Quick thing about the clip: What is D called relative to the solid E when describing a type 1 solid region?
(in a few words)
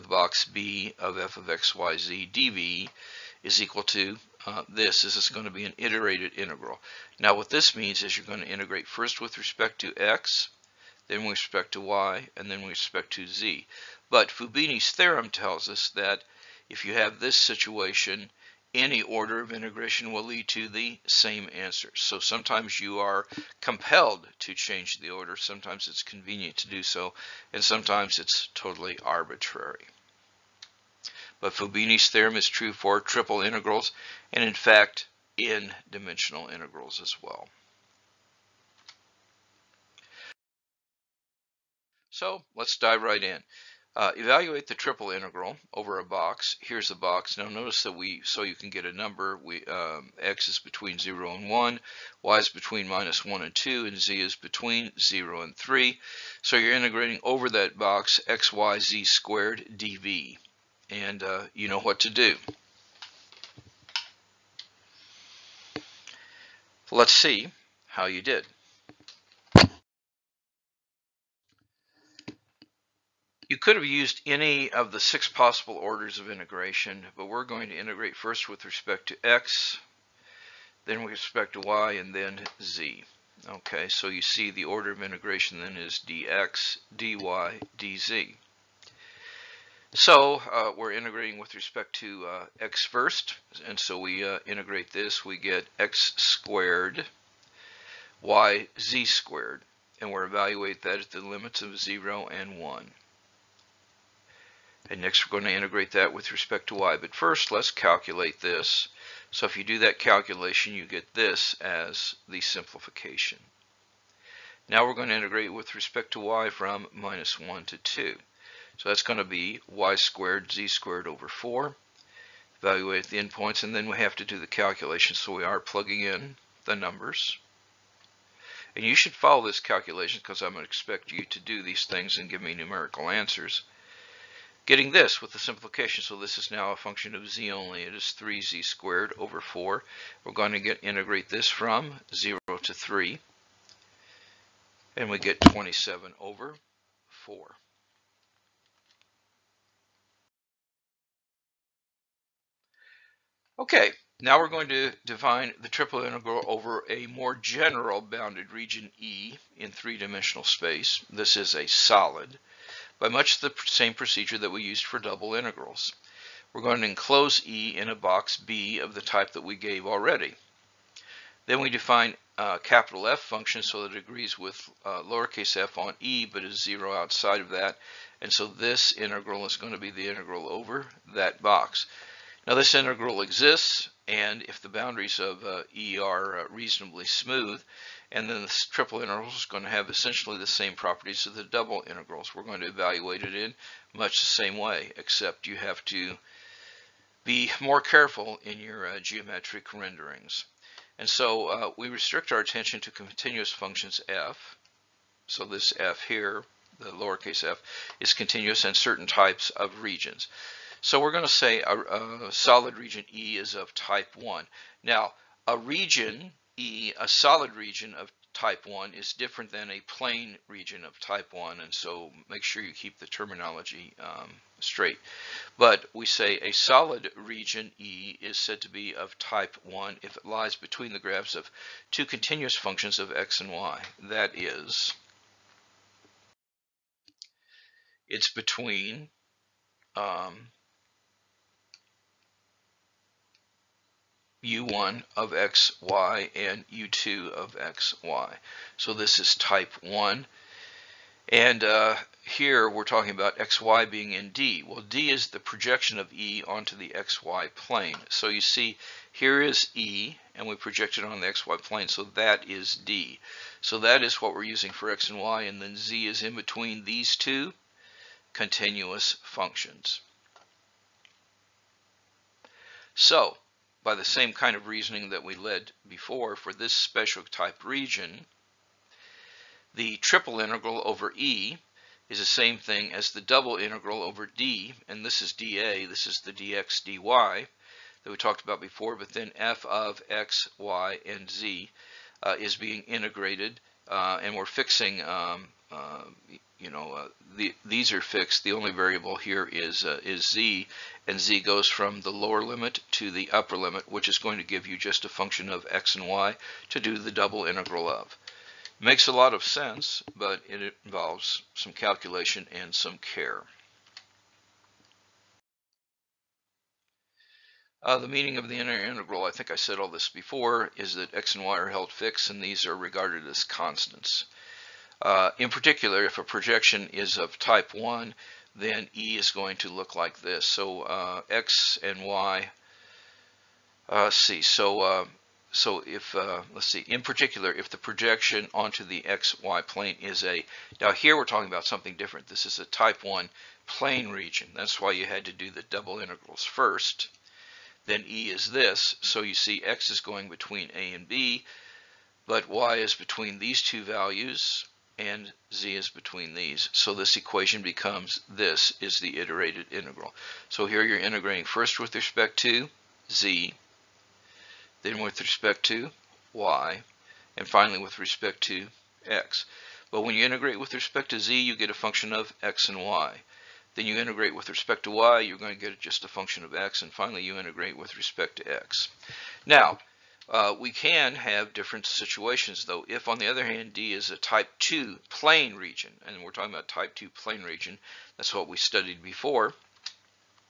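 projection onto the xy plane.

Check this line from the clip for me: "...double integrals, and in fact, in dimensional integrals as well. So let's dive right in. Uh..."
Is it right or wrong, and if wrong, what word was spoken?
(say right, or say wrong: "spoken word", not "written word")
wrong: "triple", not "double".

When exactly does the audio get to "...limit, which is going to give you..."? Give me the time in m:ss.
5:03.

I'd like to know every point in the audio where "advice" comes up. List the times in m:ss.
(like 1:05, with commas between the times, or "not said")
not said.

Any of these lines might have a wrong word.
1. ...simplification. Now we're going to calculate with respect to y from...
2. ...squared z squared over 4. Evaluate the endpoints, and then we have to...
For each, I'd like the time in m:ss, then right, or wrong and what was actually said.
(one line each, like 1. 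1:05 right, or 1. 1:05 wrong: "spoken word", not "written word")
1. 1:52 wrong: "integrate", not "calculate"
2. 1:59 right.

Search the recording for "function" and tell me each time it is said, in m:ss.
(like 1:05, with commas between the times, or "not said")
2:16, 2:53, 3:23, 3:52, 4:29, 5:05, 6:11, 6:16.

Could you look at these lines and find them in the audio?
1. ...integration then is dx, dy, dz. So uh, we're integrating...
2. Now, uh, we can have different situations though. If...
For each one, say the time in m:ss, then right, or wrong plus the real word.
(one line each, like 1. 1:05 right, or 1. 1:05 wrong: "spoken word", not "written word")
1. 1:25 right
2. 6:19 right.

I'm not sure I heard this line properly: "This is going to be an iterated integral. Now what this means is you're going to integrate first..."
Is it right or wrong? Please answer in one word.
right.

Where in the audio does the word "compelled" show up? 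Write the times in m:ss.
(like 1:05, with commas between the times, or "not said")
0:23.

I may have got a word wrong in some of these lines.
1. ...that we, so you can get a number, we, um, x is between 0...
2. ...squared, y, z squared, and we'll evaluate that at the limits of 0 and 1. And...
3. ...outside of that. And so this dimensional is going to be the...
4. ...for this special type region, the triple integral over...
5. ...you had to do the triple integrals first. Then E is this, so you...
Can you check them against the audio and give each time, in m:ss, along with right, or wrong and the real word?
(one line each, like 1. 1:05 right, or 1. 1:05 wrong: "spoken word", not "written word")
1. 0:47 right
2. 1:36 right
3. 2:56 wrong: "integral", not "dimensional"
4. 4:36 right
5. 5:44 wrong: "double", not "triple".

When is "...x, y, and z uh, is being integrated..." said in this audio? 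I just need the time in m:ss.
4:50.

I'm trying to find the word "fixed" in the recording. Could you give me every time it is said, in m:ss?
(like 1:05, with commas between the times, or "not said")
4:58, 5:21.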